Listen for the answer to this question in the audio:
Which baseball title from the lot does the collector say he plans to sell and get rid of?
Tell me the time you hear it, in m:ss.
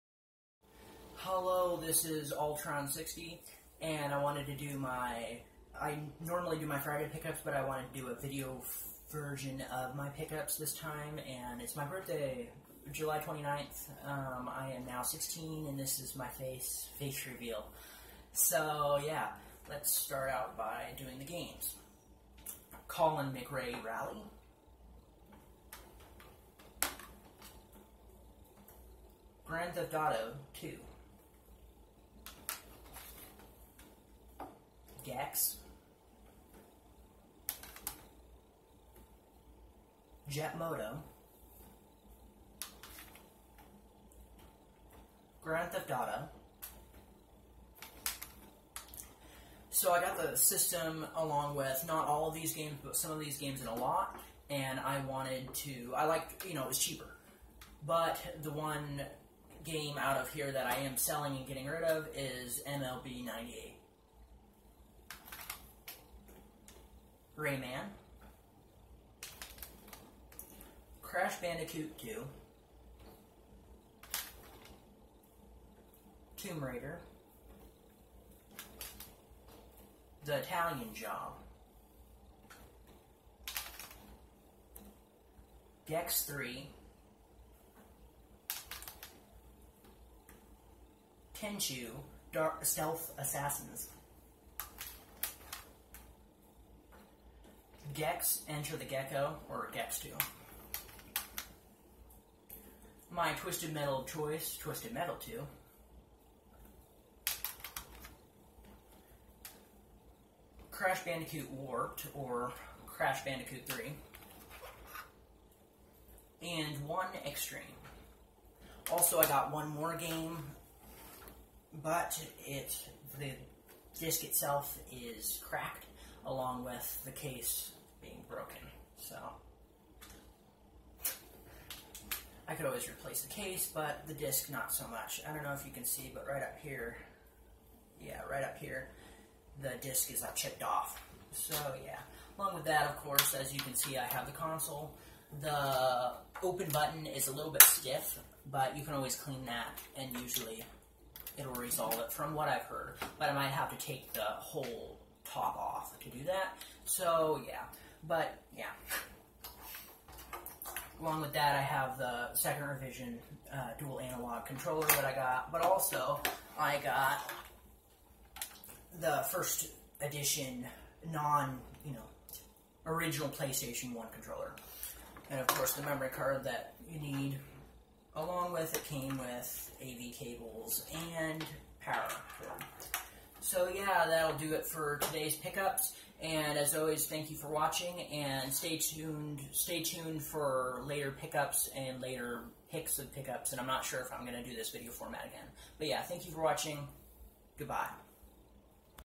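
1:02.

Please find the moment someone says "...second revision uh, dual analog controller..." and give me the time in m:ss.
2:42.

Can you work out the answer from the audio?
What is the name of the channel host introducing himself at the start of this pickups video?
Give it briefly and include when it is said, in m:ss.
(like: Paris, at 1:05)
Ultron60, at 0:02.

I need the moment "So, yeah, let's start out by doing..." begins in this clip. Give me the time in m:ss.
0:18.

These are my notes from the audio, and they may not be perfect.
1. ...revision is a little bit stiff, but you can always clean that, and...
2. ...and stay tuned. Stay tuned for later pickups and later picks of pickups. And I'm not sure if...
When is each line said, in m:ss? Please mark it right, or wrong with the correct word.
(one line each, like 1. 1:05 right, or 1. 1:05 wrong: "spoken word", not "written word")
1. 2:26 wrong: "button", not "revision"
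2. 3:08 right.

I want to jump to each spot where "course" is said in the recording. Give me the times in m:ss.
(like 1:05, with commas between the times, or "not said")
2:22, 2:55.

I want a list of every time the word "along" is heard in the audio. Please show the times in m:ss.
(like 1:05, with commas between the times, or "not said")
0:51, 2:06, 2:22, 2:41, 2:58.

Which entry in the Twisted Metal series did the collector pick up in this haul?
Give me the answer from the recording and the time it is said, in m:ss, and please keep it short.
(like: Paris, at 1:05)
Twisted Metal 2, at 1:44.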